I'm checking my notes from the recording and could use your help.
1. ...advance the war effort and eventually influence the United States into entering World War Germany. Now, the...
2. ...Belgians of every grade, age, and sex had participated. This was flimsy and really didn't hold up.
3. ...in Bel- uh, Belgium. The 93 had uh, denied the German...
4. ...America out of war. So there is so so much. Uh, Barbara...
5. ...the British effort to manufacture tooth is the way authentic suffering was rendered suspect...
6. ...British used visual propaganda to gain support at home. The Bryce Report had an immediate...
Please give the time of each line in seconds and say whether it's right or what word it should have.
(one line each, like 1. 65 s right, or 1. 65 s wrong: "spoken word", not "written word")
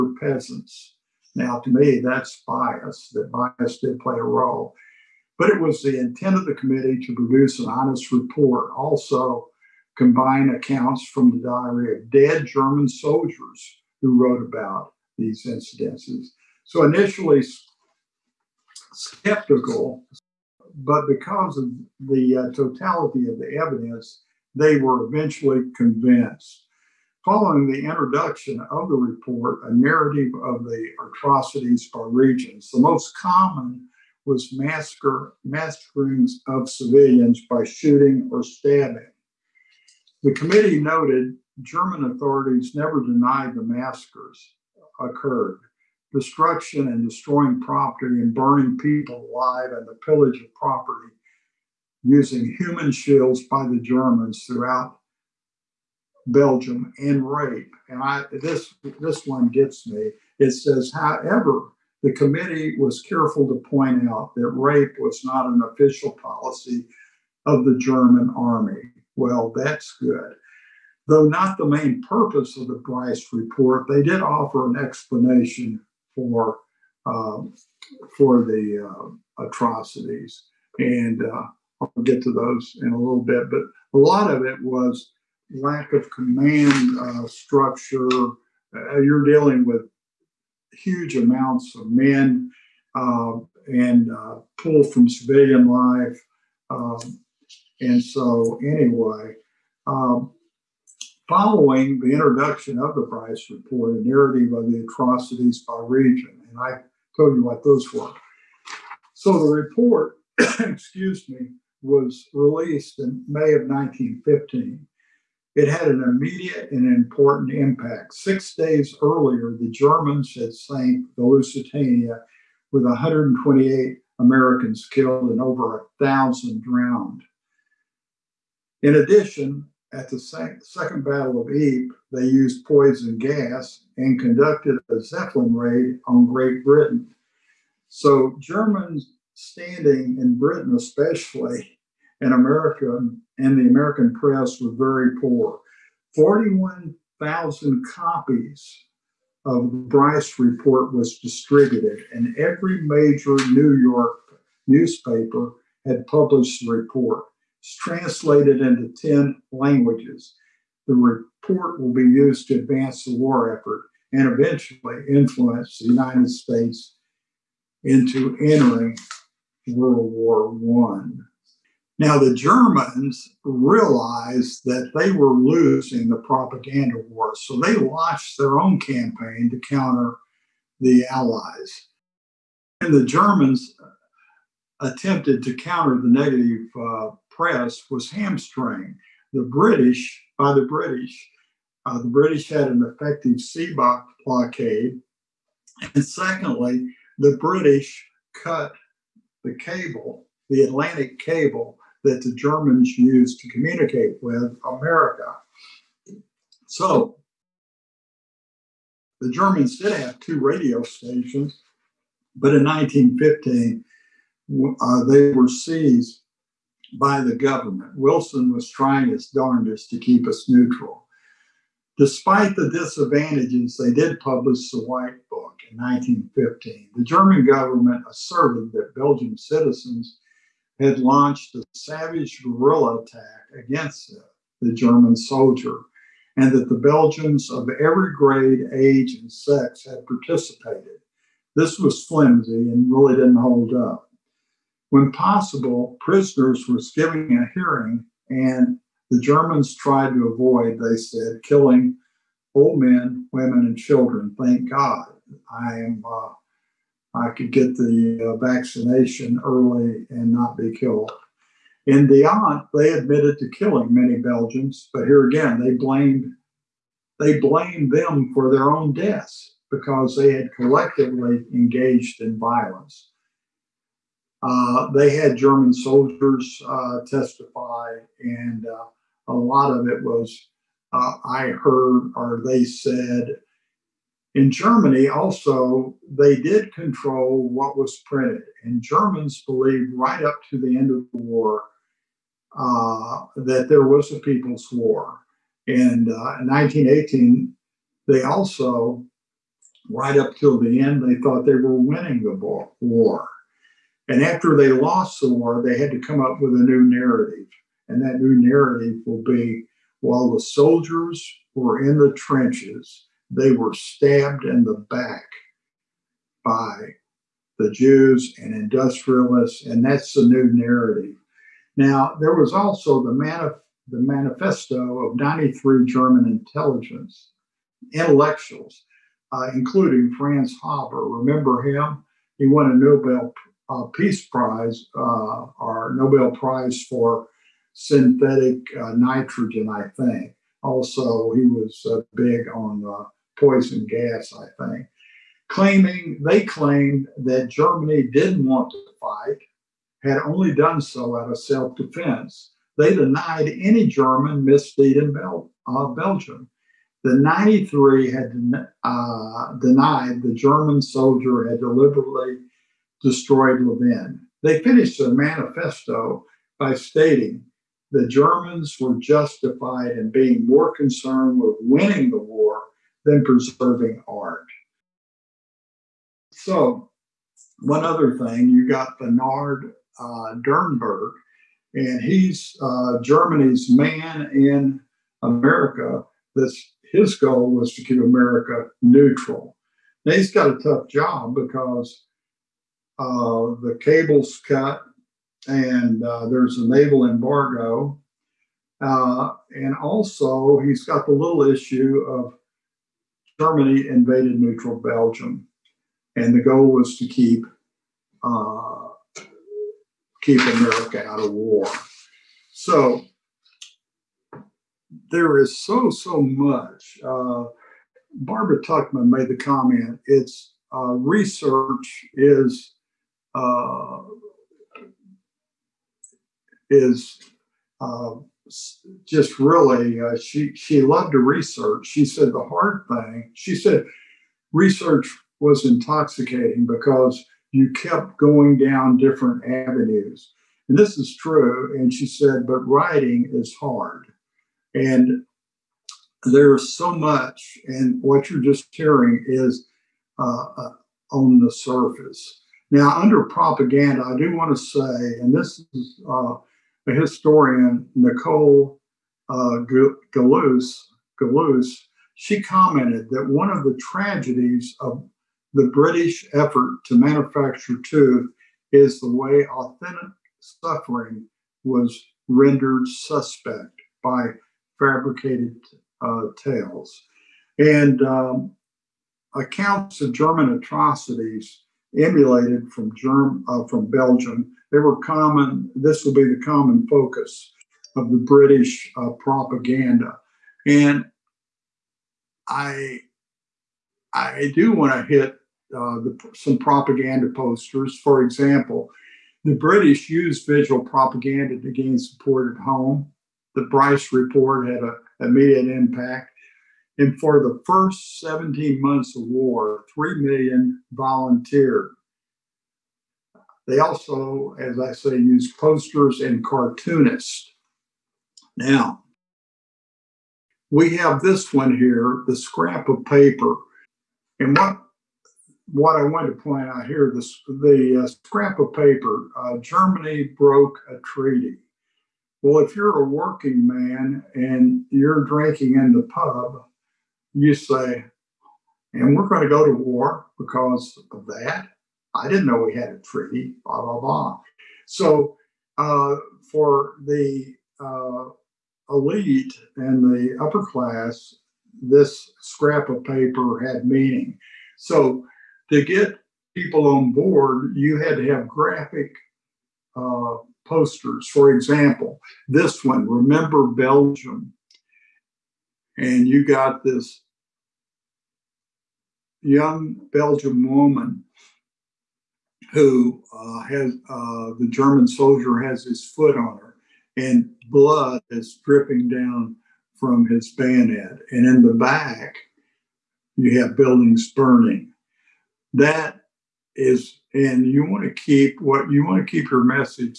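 1. 162 s wrong: "One", not "Germany"
2. 236 s right
3. 354 s right
4. 410 s right
5. 465 s right
6. 499 s right.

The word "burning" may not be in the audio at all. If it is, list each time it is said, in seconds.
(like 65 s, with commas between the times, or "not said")
48 s, 584 s.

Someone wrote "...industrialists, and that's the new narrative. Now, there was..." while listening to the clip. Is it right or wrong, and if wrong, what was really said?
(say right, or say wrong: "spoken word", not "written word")
right.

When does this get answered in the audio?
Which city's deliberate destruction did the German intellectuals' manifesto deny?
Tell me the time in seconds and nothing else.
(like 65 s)
363 s.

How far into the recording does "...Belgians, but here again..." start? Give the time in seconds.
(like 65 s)
264 s.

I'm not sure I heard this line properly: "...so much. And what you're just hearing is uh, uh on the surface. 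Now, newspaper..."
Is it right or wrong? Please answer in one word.
wrong.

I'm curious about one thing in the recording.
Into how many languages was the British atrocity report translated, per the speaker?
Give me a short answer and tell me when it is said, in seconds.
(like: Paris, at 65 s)
10, at 159 s.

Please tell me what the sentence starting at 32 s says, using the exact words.
The most common was massacre, massacrings of civilians by shooting or stabbing.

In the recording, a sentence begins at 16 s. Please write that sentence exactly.
So initially skeptical, but because of the uh, totality of the evidence, they were eventually convinced.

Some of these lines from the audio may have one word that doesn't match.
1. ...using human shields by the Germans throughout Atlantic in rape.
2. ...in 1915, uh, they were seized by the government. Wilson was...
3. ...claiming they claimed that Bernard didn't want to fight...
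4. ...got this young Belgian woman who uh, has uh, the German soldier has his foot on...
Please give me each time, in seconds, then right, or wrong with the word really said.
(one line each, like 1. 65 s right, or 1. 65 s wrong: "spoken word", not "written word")
1. 52 s wrong: "Belgium", not "Atlantic"
2. 212 s right
3. 345 s wrong: "Germany", not "Bernard"
4. 566 s right.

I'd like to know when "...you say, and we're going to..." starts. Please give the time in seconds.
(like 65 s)
537 s.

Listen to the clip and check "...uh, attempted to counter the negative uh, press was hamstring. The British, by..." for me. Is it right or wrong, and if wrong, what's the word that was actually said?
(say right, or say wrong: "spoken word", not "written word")
right.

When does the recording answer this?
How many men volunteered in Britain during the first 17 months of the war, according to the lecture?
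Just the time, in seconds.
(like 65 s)
509 s.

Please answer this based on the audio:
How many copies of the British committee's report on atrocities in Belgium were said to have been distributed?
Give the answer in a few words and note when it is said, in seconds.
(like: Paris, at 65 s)
41,000, at 146 s.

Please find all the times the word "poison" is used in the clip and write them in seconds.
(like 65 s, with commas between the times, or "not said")
132 s, 343 s.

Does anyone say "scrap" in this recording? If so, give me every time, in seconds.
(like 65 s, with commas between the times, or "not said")
522 s, 528 s, 552 s.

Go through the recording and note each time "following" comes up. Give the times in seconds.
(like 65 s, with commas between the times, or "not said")
27 s, 101 s.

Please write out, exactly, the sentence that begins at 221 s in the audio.
Despite the disadvantages, they did publish the White Book in 1915.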